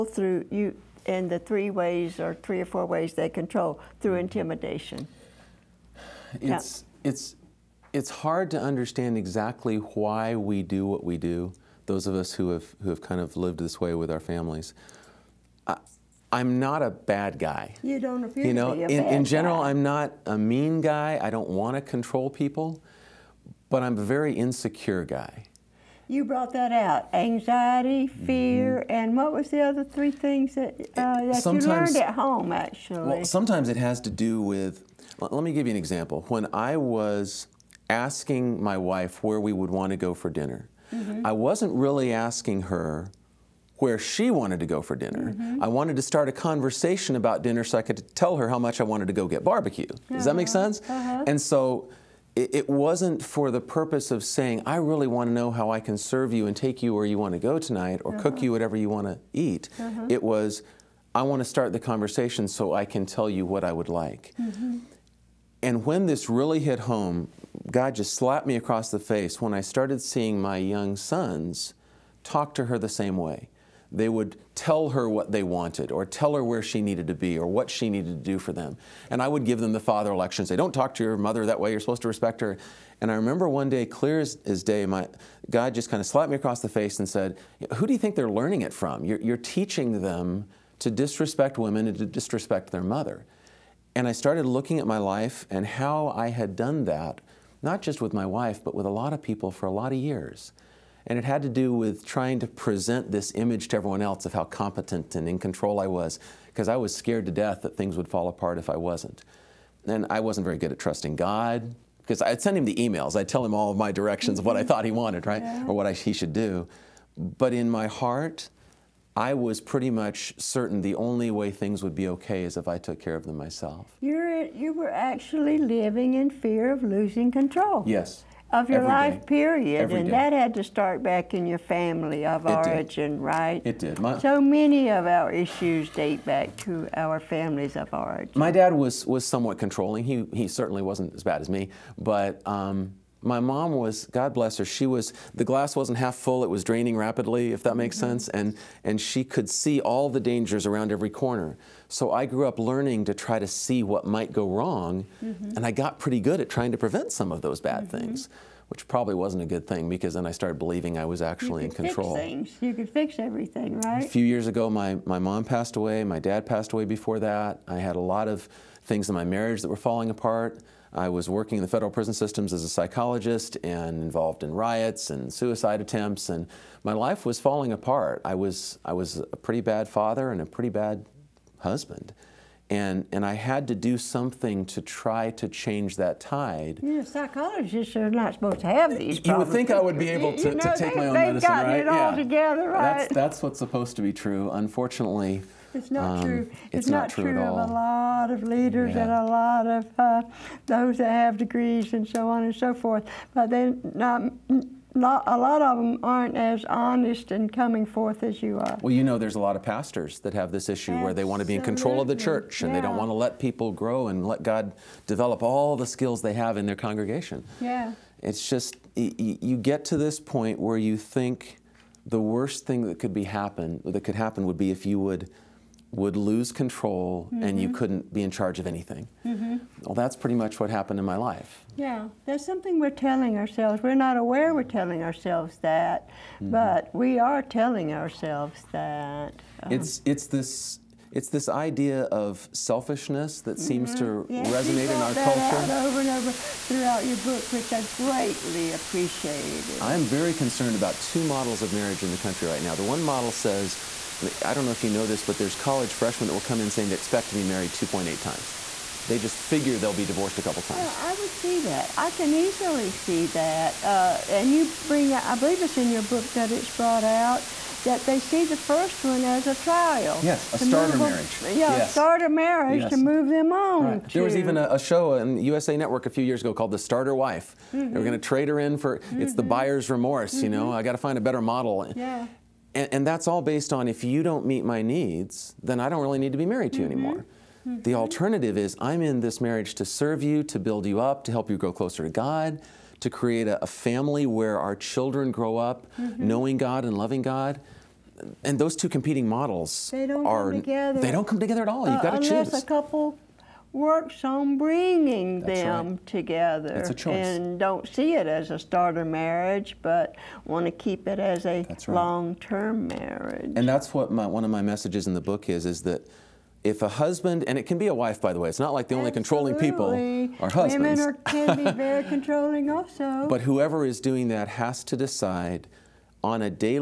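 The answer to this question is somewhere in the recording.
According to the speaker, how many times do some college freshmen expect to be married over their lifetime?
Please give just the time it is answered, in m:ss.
4:17.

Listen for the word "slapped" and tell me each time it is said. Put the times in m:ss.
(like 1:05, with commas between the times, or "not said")
1:08, 1:26.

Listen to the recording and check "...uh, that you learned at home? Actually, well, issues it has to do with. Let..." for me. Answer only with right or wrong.
wrong.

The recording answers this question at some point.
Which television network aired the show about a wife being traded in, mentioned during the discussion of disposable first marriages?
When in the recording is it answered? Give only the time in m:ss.
4:35.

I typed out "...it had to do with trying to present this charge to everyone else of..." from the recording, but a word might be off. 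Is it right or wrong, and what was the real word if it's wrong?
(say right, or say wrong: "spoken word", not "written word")
wrong: "image", not "charge".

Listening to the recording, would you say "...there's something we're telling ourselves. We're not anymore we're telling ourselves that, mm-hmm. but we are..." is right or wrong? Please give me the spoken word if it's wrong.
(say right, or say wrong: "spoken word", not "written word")
wrong: "aware", not "anymore".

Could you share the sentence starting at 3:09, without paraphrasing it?
You would think I would be able to, you know, to take they, my own medicine, right?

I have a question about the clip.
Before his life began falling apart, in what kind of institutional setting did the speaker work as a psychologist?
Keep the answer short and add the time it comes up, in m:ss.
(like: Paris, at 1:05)
federal prison systems, at 2:51.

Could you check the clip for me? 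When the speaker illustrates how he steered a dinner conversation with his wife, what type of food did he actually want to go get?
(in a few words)
barbecue.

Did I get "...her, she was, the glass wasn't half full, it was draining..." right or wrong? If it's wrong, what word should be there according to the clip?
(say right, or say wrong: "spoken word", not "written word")
right.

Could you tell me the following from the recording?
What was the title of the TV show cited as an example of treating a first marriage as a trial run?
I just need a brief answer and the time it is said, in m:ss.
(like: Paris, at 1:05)
The Starter Wife, at 4:36.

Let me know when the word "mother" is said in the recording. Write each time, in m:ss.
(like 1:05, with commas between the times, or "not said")
1:21, 1:32.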